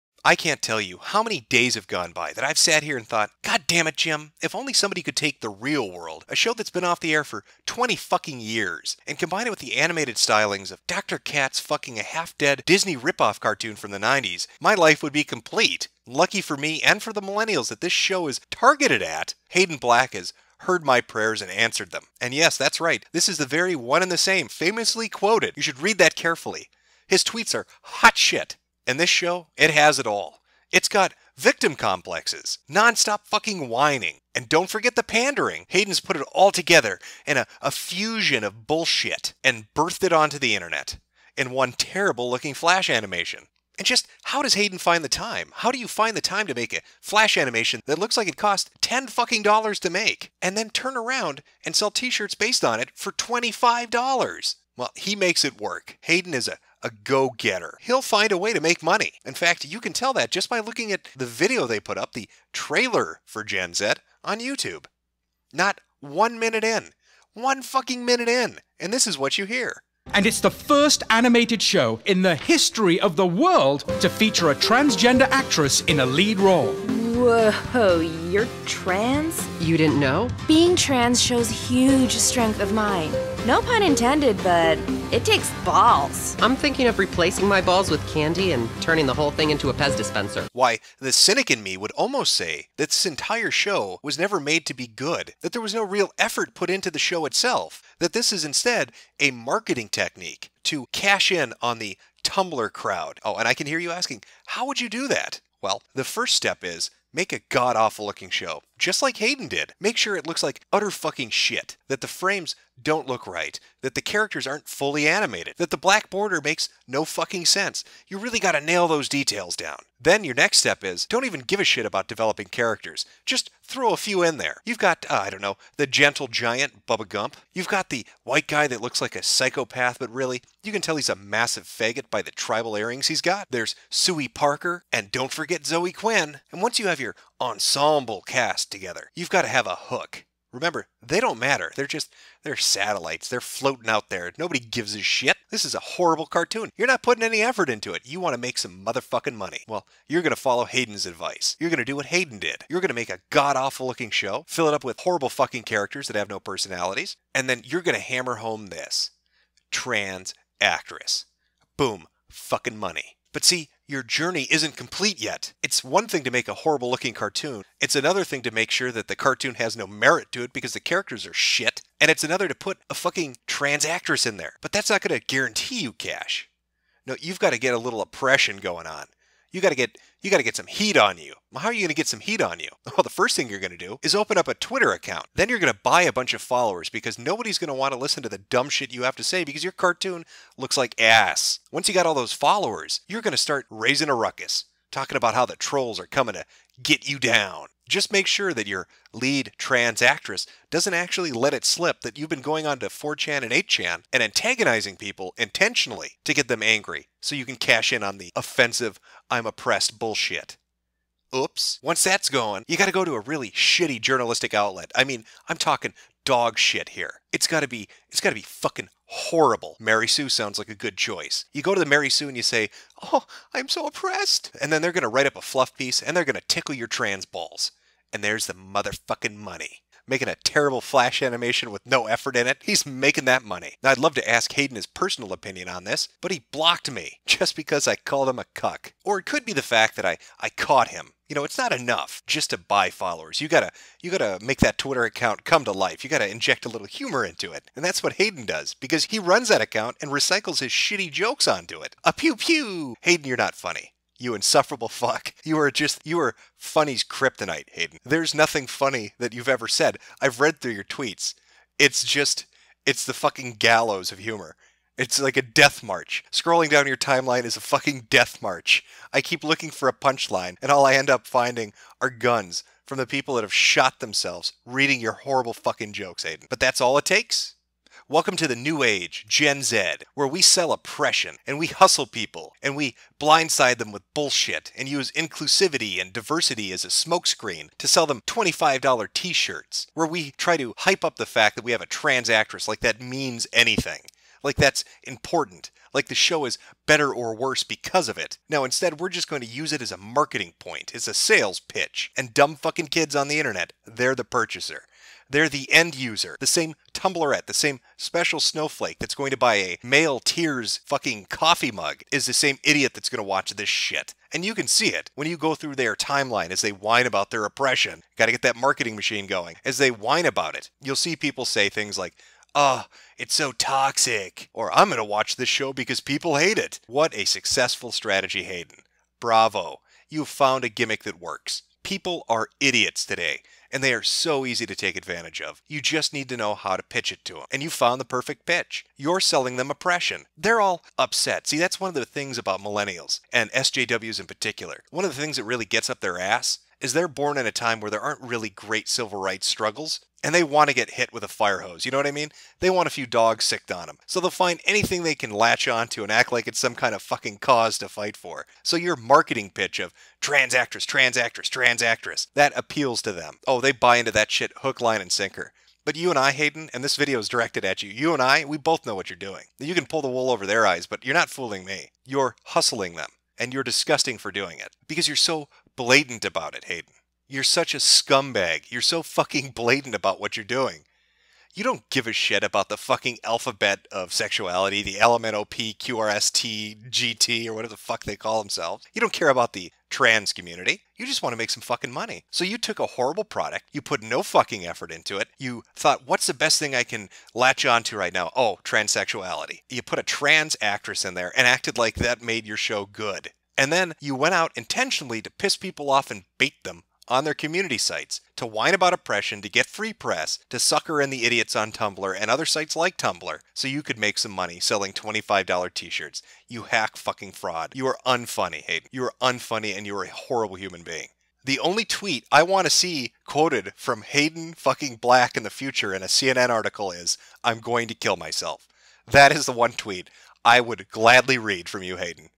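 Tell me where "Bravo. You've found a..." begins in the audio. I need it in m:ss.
5:29.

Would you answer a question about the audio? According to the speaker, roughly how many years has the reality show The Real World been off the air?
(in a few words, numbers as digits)
20.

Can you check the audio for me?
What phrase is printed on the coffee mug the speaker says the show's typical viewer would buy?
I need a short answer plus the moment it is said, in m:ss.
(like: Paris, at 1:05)
male tears, at 5:09.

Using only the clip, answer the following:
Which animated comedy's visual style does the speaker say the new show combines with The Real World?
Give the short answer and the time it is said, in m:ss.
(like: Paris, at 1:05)
Dr. Katz, at 0:10.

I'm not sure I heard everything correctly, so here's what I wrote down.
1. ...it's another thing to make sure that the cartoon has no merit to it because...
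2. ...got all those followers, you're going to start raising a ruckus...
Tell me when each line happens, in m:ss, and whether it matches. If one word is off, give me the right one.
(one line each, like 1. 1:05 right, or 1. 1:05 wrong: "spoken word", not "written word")
1. 2:47 right
2. 3:11 right.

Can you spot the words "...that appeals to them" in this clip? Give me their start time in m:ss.
6:02.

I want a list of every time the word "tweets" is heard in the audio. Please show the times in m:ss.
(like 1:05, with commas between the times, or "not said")
0:27, 4:20, 7:01, 7:09.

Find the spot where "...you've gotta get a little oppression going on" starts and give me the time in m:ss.
2:57.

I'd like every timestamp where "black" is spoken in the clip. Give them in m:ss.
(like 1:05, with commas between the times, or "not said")
0:19, 1:55, 7:04.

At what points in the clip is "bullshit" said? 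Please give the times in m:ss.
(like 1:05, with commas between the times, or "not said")
0:38, 3:29, 4:44.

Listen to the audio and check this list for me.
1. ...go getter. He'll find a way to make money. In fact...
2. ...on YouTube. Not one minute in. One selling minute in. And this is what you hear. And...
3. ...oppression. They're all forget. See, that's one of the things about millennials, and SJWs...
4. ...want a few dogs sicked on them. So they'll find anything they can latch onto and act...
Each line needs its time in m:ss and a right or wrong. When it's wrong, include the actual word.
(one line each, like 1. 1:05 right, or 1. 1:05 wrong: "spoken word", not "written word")
1. 0:57 right
2. 1:04 wrong: "fucking", not "selling"
3. 5:39 wrong: "upset", not "forget"
4. 5:52 right.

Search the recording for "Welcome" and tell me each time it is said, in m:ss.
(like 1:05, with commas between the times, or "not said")
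4:38.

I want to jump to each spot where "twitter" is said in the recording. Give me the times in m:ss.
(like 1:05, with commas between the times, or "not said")
3:04, 4:04.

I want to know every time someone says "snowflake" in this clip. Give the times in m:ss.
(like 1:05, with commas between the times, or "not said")
5:08.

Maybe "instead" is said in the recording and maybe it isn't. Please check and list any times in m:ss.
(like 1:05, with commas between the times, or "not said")
1:38, 4:58.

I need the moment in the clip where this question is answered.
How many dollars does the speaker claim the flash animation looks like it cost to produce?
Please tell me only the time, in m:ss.
0:48.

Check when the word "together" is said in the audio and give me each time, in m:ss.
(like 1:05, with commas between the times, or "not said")
0:36, 2:18.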